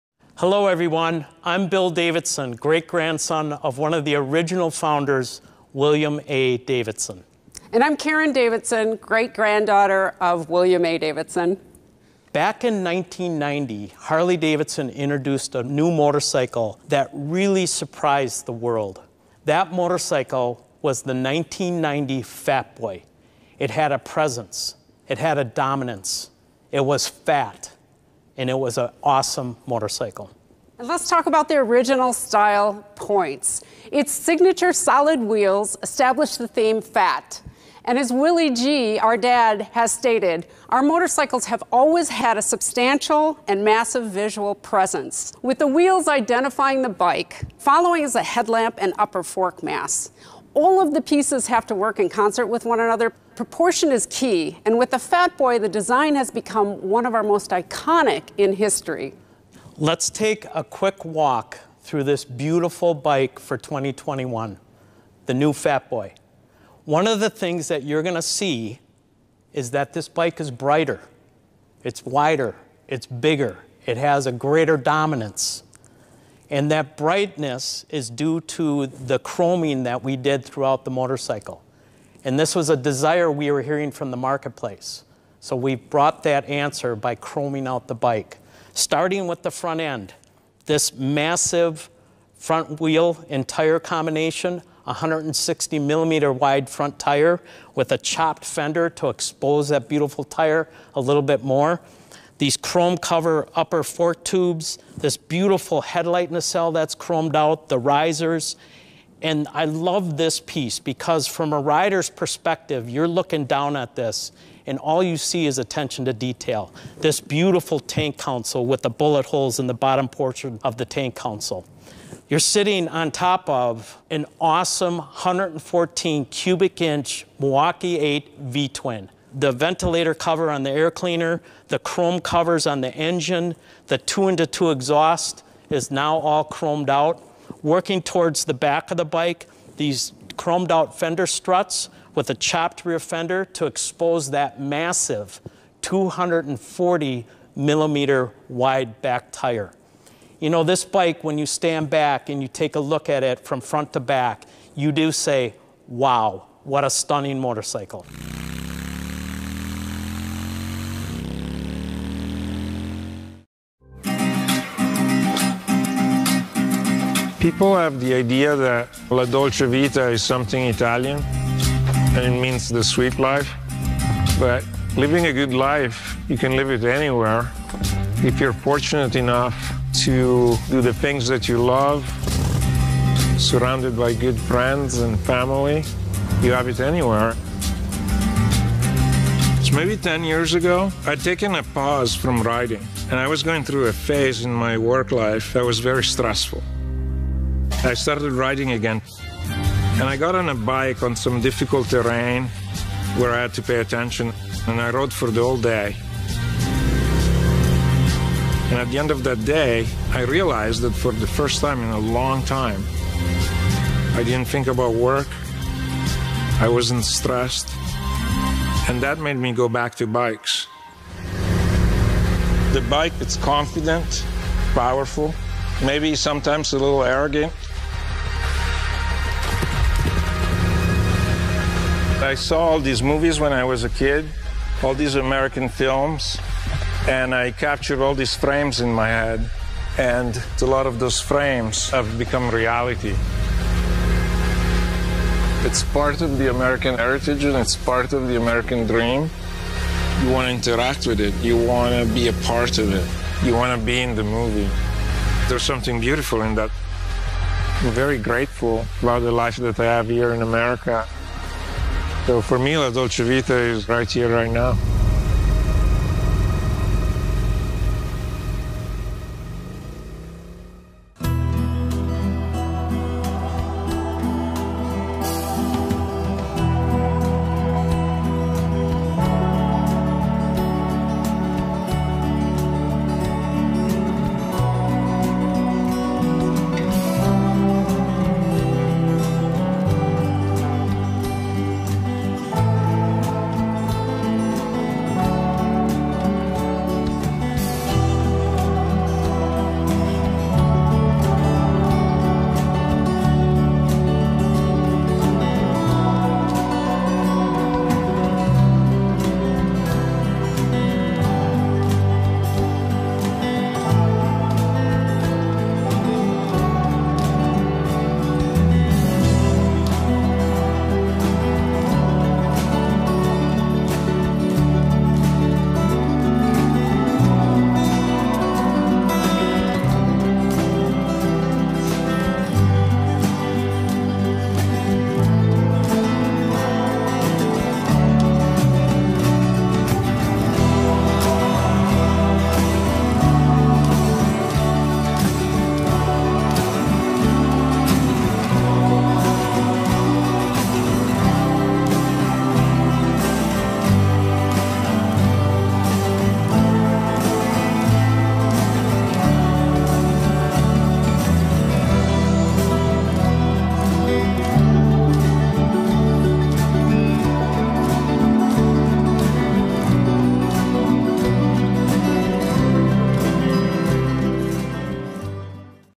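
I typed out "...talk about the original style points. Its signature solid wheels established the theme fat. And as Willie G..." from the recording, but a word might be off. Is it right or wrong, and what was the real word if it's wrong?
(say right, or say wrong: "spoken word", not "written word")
right.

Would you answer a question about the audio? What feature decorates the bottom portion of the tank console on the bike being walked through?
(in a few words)
bullet holes.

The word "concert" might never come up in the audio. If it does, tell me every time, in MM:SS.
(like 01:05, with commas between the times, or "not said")
00:52.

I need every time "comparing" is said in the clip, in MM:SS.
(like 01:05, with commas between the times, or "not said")
not said.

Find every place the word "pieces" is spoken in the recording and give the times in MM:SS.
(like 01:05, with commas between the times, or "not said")
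00:51, 01:50.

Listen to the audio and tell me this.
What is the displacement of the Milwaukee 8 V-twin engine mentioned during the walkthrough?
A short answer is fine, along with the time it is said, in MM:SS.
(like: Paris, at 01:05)
114 cubic inches, at 02:04.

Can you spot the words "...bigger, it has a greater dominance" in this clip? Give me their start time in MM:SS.
01:13.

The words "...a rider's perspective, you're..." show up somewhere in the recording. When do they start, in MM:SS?
01:51.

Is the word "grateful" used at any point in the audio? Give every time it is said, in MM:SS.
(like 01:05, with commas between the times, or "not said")
04:18.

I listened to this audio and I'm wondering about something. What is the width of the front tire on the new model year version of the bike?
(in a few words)
160 millimeters.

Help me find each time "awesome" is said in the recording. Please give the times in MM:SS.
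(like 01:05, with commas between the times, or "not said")
00:29, 02:04.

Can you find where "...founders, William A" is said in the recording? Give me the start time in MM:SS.
00:04.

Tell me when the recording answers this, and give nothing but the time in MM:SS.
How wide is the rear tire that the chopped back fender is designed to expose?
02:25.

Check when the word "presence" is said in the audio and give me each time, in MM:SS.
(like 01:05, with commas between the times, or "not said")
00:23, 00:44.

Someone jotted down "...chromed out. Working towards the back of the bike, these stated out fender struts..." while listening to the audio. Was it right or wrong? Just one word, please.
wrong.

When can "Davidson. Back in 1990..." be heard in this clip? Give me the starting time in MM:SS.
00:10.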